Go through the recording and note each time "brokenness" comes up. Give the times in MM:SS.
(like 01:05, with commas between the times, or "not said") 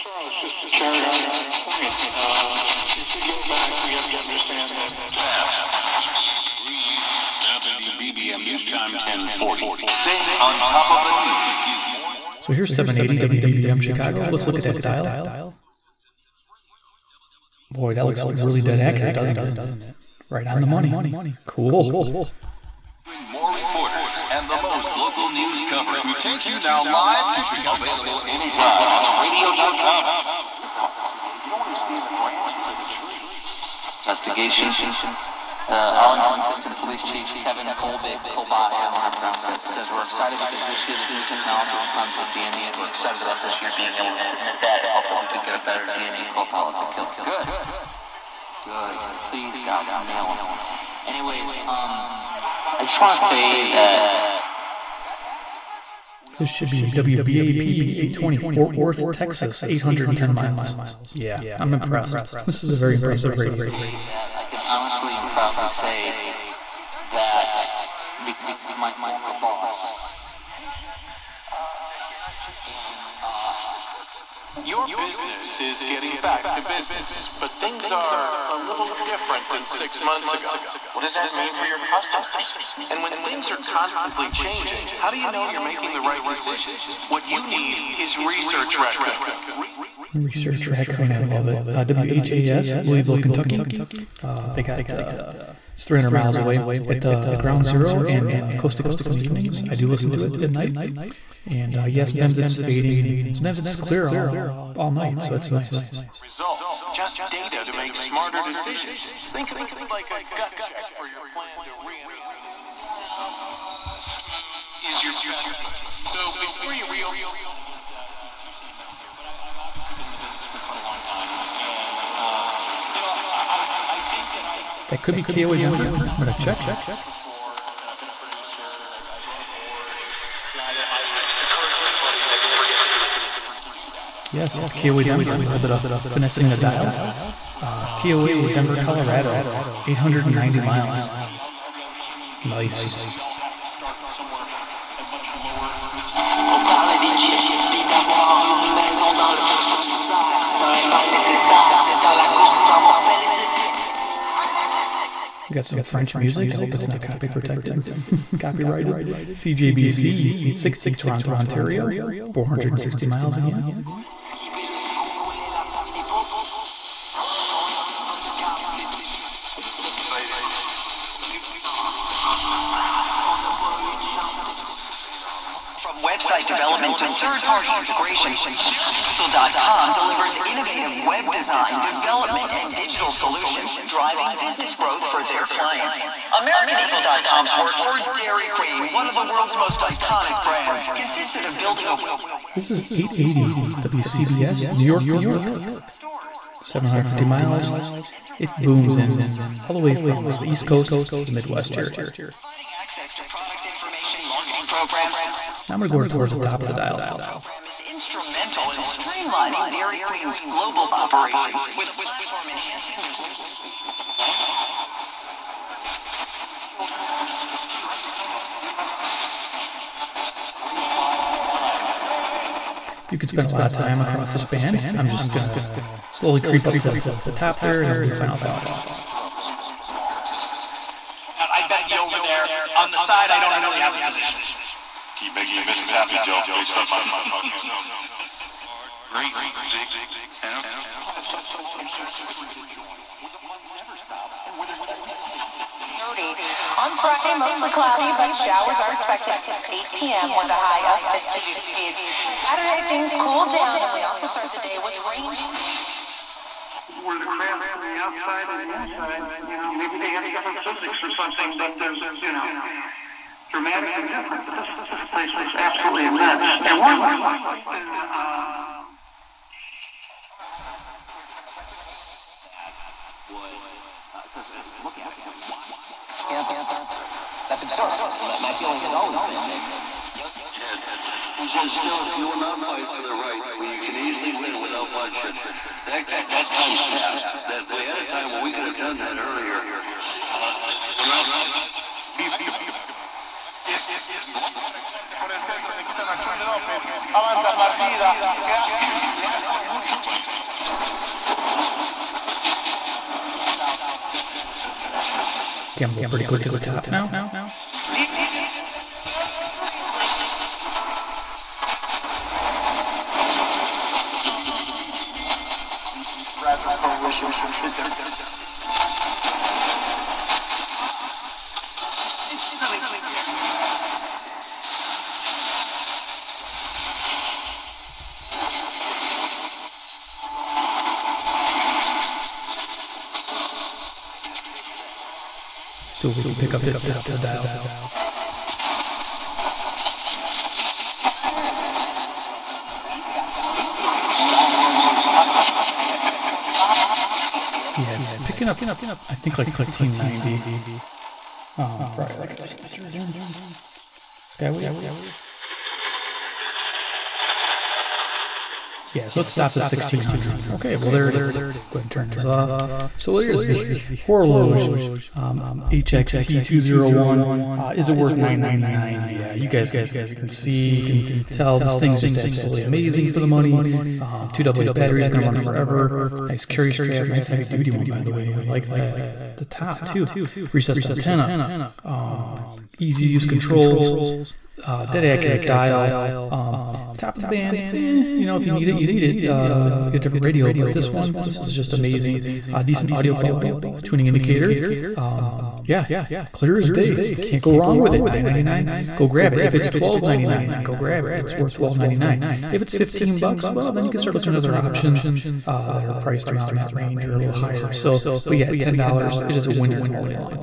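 not said.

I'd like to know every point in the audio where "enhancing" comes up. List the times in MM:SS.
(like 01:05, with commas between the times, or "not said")
03:32.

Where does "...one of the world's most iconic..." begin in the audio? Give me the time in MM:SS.
03:08.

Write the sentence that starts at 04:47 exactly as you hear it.
That we had a time where we could have done that earlier.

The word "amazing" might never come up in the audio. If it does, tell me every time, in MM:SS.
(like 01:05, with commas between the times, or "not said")
06:12, 06:31.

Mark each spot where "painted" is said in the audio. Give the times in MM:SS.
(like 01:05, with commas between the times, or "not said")
not said.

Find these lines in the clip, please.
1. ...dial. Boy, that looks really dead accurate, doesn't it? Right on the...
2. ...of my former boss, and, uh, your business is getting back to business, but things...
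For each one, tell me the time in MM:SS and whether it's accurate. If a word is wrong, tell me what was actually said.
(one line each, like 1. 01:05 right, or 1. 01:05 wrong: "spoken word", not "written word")
1. 00:14 right
2. 01:08 right.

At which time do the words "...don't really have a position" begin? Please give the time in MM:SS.
03:53.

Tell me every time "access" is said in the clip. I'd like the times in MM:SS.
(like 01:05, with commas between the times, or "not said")
03:22.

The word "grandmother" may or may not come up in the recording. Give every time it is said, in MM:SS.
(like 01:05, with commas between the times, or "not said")
not said.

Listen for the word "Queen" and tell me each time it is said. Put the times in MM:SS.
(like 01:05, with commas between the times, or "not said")
03:08, 03:30.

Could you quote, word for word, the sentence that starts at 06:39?
If it's twelve ninety nine, go grab it.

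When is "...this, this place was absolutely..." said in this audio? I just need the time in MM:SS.
04:24.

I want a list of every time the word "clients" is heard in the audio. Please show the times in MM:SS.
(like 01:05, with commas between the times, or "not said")
03:05.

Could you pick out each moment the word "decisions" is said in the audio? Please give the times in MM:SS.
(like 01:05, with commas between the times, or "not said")
01:26, 01:48.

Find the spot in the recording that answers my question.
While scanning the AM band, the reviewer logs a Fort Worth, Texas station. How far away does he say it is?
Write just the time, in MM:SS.
00:59.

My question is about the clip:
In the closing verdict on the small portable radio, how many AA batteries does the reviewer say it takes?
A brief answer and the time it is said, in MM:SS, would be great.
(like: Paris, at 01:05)
2, at 06:14.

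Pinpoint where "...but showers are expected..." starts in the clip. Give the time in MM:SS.
04:08.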